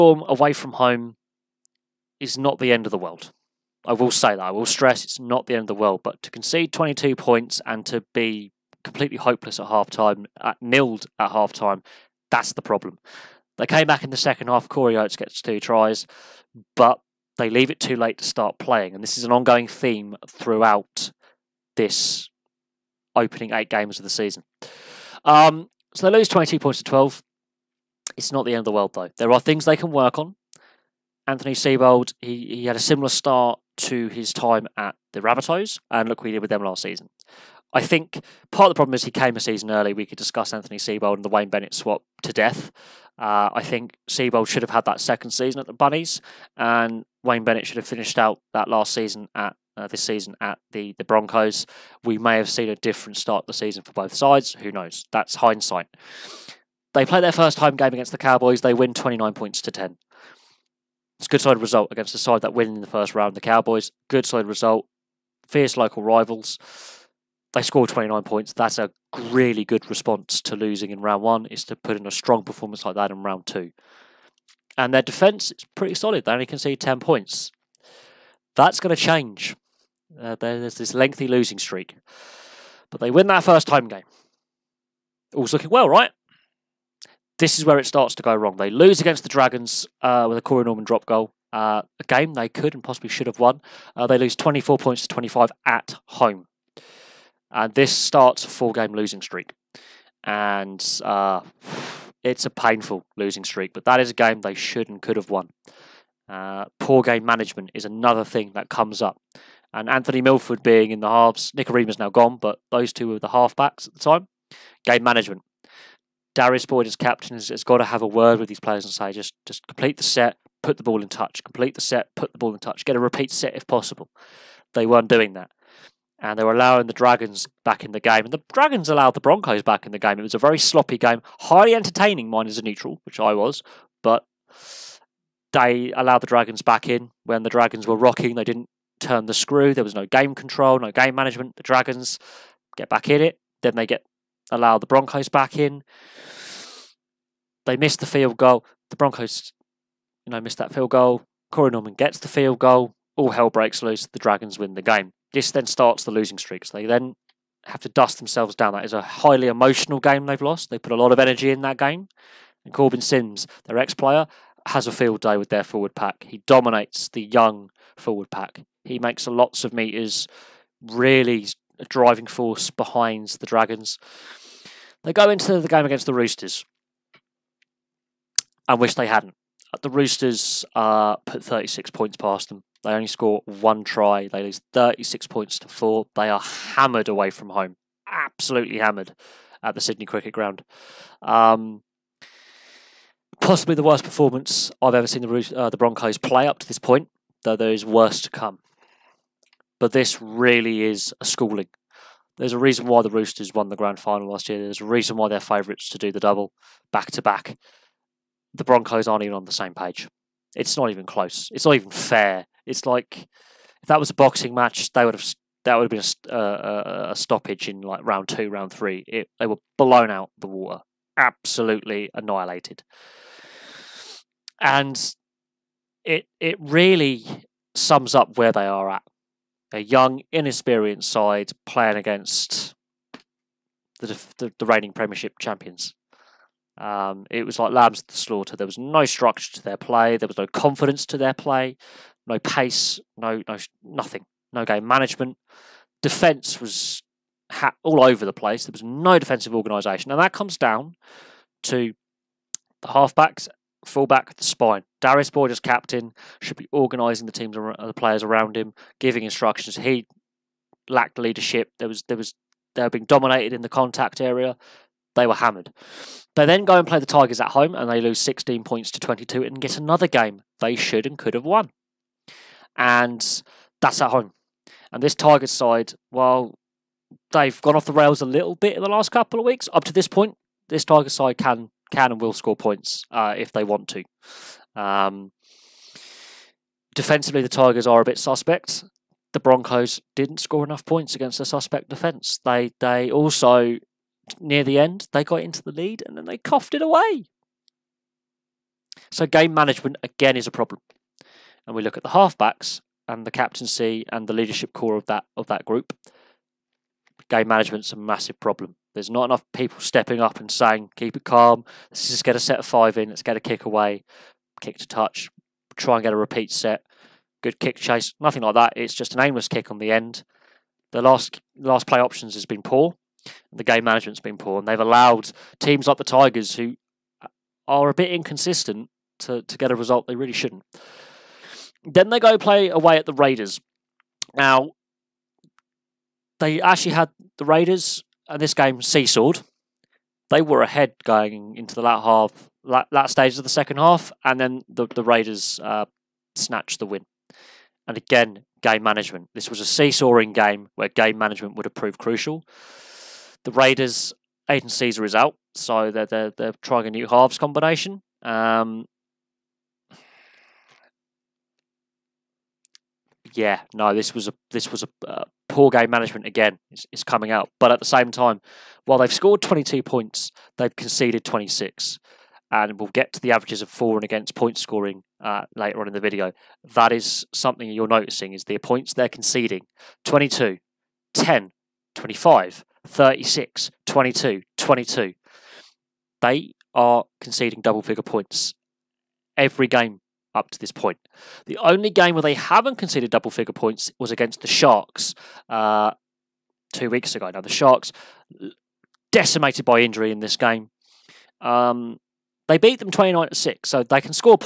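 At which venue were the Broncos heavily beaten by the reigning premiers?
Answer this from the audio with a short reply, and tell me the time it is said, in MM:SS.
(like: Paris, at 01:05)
Sydney Cricket Ground, at 03:09.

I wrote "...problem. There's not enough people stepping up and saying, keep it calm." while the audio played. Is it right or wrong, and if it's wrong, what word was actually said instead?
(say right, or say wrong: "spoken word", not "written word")
right.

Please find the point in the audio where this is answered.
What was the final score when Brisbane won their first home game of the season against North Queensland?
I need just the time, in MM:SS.
00:58.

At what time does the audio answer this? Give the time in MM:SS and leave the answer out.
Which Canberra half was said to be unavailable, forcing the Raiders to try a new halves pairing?
05:54.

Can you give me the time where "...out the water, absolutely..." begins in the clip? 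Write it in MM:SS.
03:40.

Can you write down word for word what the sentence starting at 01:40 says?
And uh, it's a painful losing streak, but that is a game they should and could have won.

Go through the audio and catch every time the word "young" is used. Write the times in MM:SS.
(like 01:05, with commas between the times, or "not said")
02:47, 03:49.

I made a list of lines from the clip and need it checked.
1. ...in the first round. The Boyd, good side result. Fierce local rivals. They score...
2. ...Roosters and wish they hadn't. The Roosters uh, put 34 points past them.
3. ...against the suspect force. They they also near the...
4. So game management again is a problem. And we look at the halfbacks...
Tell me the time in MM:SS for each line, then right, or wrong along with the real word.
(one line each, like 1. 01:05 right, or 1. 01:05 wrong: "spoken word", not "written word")
1. 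01:02 wrong: "Cowboys", not "Boyd"
2. 02:56 wrong: "36", not "34"
3. 04:51 wrong: "defence", not "force"
4. 04:59 right.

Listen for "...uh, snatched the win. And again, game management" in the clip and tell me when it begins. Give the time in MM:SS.
05:45.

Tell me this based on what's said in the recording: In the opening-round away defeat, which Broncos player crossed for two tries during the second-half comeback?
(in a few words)
Corey Oates.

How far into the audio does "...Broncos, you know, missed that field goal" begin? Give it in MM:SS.
02:28.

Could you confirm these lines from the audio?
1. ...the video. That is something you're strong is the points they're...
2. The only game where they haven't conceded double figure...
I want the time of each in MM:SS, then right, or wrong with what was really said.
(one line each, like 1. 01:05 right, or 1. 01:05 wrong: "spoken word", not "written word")
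1. 06:15 wrong: "noticing", not "strong"
2. 06:31 right.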